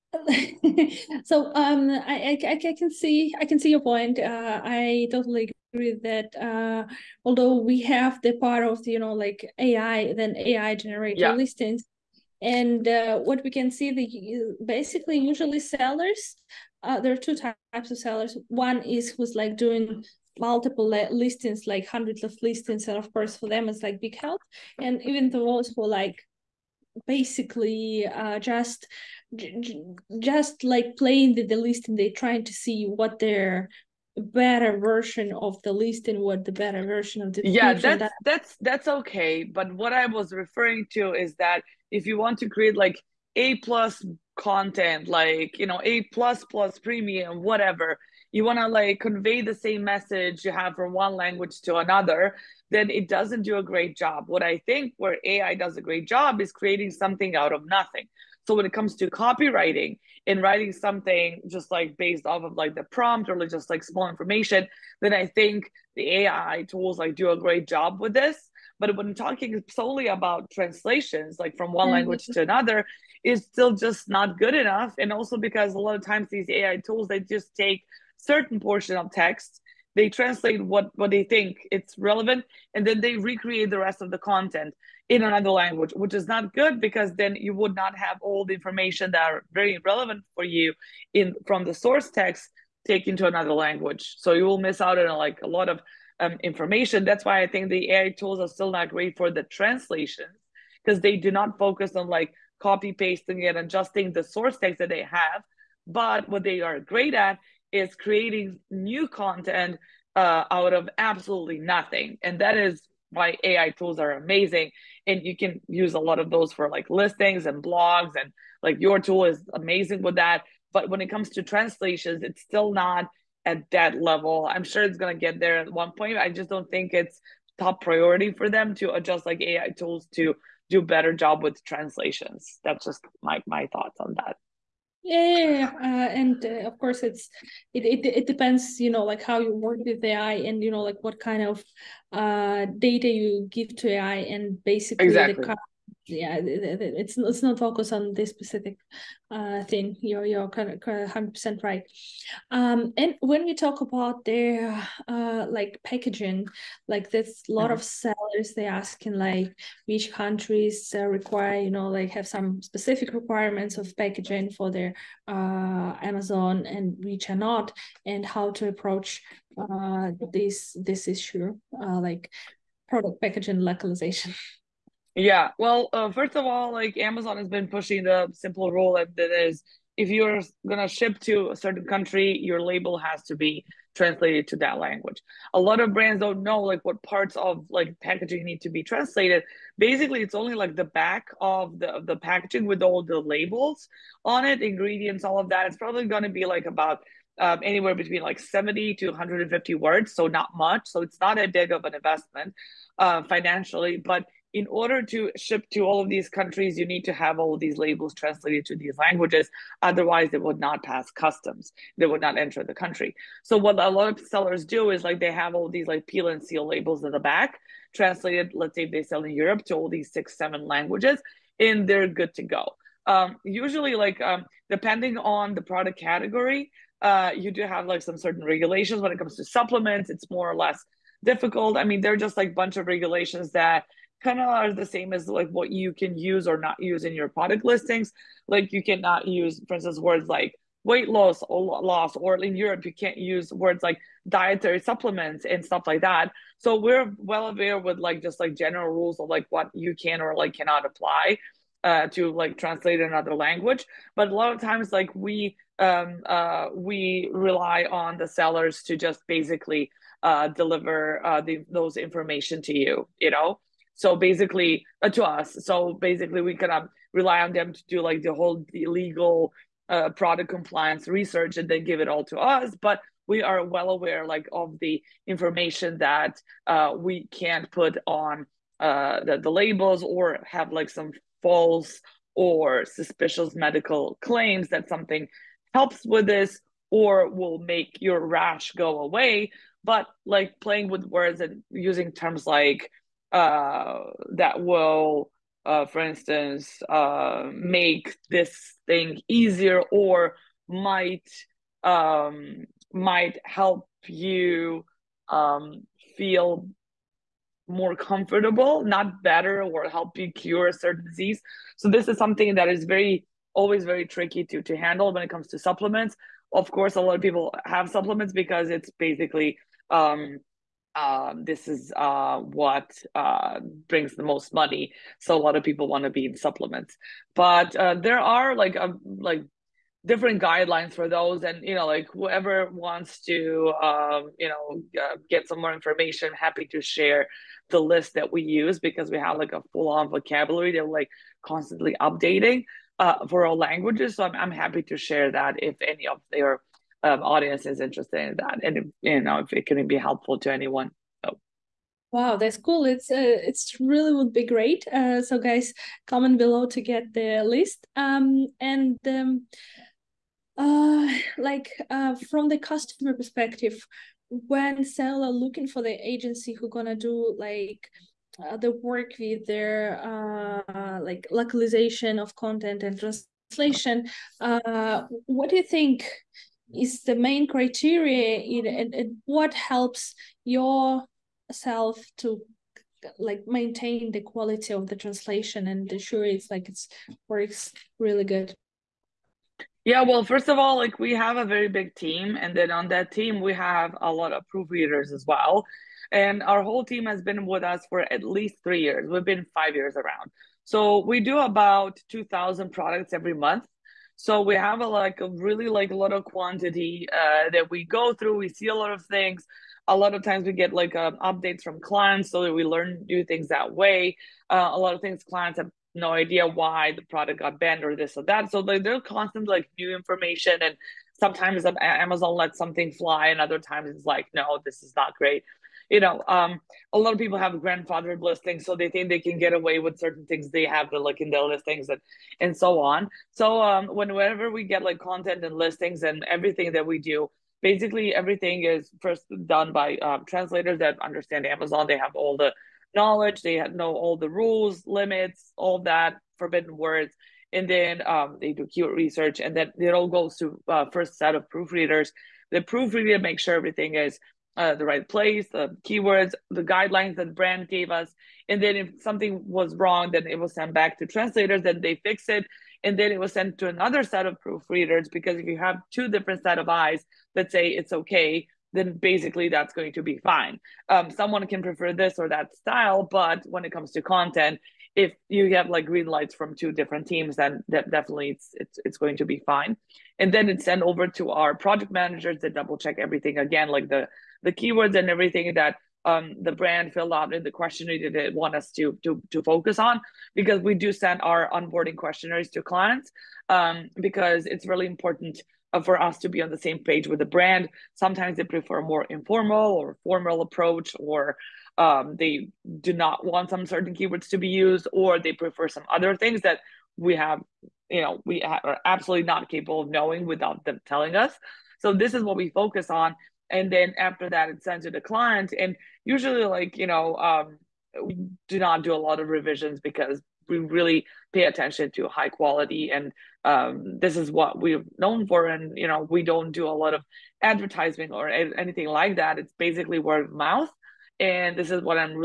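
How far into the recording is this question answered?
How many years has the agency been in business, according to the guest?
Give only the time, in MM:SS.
06:39.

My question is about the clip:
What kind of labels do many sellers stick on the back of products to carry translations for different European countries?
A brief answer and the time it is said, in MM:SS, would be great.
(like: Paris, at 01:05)
peel and seal labels, at 03:36.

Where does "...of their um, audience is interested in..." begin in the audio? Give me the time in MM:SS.
05:46.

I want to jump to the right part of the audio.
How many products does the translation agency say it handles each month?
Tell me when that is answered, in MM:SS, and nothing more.
06:42.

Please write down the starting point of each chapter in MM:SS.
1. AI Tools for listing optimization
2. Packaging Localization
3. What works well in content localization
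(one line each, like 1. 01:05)
1. 00:41
2. 02:33
3. 06:00.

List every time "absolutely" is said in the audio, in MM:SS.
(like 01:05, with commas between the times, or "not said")
01:50, 08:28.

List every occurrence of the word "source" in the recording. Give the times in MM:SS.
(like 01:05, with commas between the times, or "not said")
01:31, 01:44.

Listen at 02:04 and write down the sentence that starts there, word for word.
I'm sure it's going to get there at one point.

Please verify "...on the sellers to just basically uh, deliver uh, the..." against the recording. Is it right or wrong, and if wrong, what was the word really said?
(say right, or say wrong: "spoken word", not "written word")
right.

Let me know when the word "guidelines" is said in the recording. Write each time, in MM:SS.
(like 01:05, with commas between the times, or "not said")
05:30, 07:36.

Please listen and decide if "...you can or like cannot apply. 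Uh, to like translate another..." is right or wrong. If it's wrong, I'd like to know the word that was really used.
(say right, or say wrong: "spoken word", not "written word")
right.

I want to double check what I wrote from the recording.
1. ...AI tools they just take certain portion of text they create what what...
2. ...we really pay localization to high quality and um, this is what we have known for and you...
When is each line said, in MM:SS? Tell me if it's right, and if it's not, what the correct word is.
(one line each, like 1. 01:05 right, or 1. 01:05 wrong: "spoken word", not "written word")
1. 01:16 wrong: "translate", not "create"
2. 08:40 wrong: "attention", not "localization".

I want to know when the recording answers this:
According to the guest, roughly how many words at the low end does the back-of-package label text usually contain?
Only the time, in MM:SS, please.
03:18.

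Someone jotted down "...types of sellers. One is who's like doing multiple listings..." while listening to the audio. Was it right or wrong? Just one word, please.
right.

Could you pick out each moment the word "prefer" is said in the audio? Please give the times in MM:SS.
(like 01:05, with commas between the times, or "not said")
07:51, 08:18, 08:25.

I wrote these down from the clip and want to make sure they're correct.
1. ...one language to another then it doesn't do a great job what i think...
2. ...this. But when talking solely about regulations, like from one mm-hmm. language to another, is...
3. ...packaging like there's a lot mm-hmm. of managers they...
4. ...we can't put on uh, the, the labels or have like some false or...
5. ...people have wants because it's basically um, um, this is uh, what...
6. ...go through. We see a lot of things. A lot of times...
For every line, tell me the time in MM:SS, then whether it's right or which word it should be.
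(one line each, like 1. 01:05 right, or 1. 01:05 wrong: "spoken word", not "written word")
1. 00:50 right
2. 01:08 wrong: "translations", not "regulations"
3. 02:35 wrong: "sellers", not "managers"
4. 04:36 right
5. 05:17 wrong: "supplements", not "wants"
6. 06:47 right.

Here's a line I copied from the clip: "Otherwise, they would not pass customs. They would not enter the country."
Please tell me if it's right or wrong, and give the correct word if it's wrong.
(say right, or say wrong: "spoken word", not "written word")
right.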